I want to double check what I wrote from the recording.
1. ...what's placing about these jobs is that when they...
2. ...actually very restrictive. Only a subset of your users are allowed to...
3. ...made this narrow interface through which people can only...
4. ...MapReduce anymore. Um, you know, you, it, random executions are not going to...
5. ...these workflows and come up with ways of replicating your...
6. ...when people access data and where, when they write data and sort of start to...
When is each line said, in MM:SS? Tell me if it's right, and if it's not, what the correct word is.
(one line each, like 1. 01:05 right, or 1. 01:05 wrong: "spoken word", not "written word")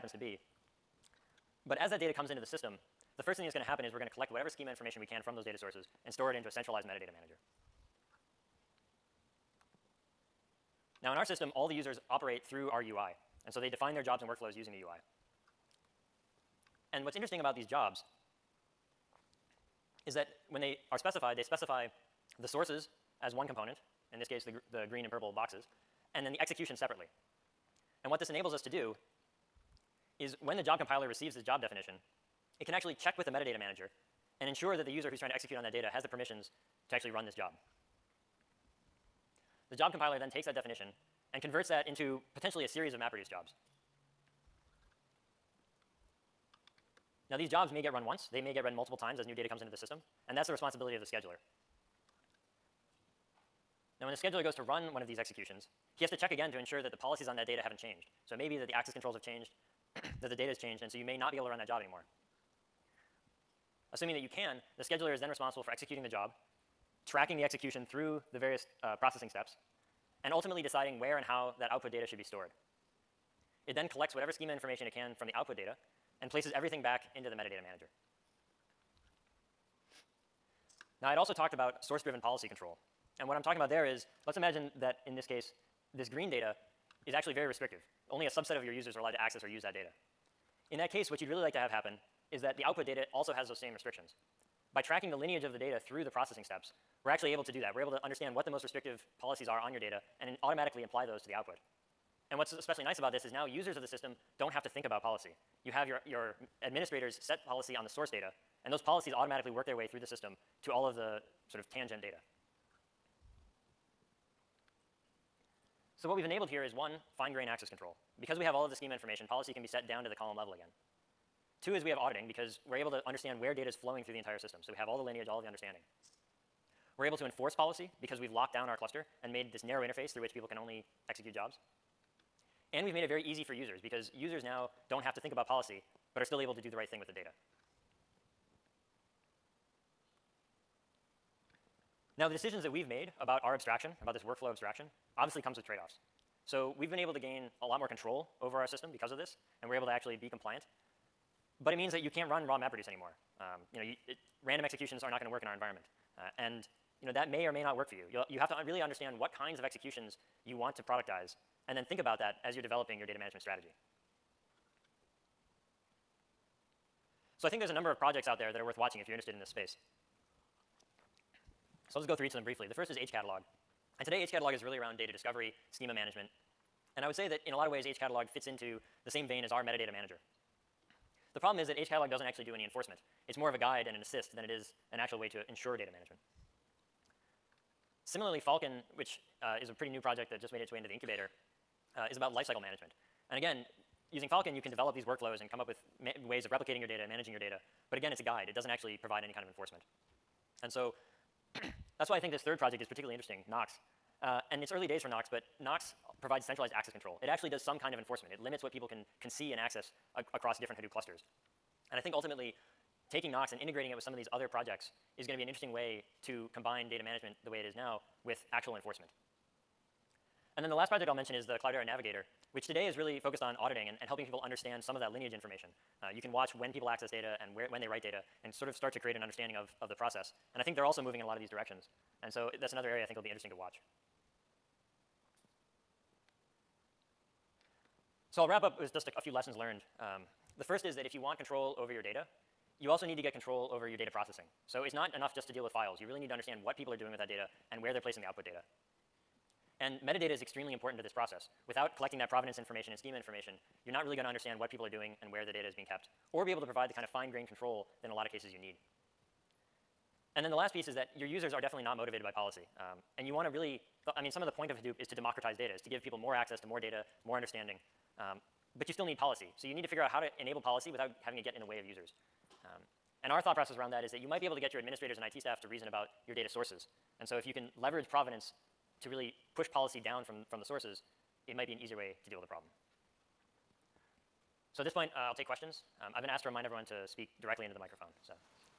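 1. 00:17 wrong: "interesting", not "placing"
2. 01:27 right
3. 02:09 right
4. 02:32 right
5. 03:14 right
6. 03:46 right.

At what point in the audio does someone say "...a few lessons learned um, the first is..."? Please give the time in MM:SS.
03:59.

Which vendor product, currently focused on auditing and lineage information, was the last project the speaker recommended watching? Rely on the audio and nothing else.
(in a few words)
Cloudera Navigator.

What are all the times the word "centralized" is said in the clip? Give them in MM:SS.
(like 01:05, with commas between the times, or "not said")
00:06, 03:26.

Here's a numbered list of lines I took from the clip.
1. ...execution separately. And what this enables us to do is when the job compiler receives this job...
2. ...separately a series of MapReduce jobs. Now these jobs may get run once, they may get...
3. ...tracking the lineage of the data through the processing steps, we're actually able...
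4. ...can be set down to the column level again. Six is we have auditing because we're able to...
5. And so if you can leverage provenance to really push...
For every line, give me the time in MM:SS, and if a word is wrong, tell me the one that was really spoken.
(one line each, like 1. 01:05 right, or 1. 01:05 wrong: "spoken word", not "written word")
1. 00:26 right
2. 00:42 wrong: "potentially", not "separately"
3. 01:34 right
4. 01:59 wrong: "Two", not "Six"
5. 04:37 right.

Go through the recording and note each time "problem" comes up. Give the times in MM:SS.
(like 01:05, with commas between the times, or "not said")
03:01, 04:42.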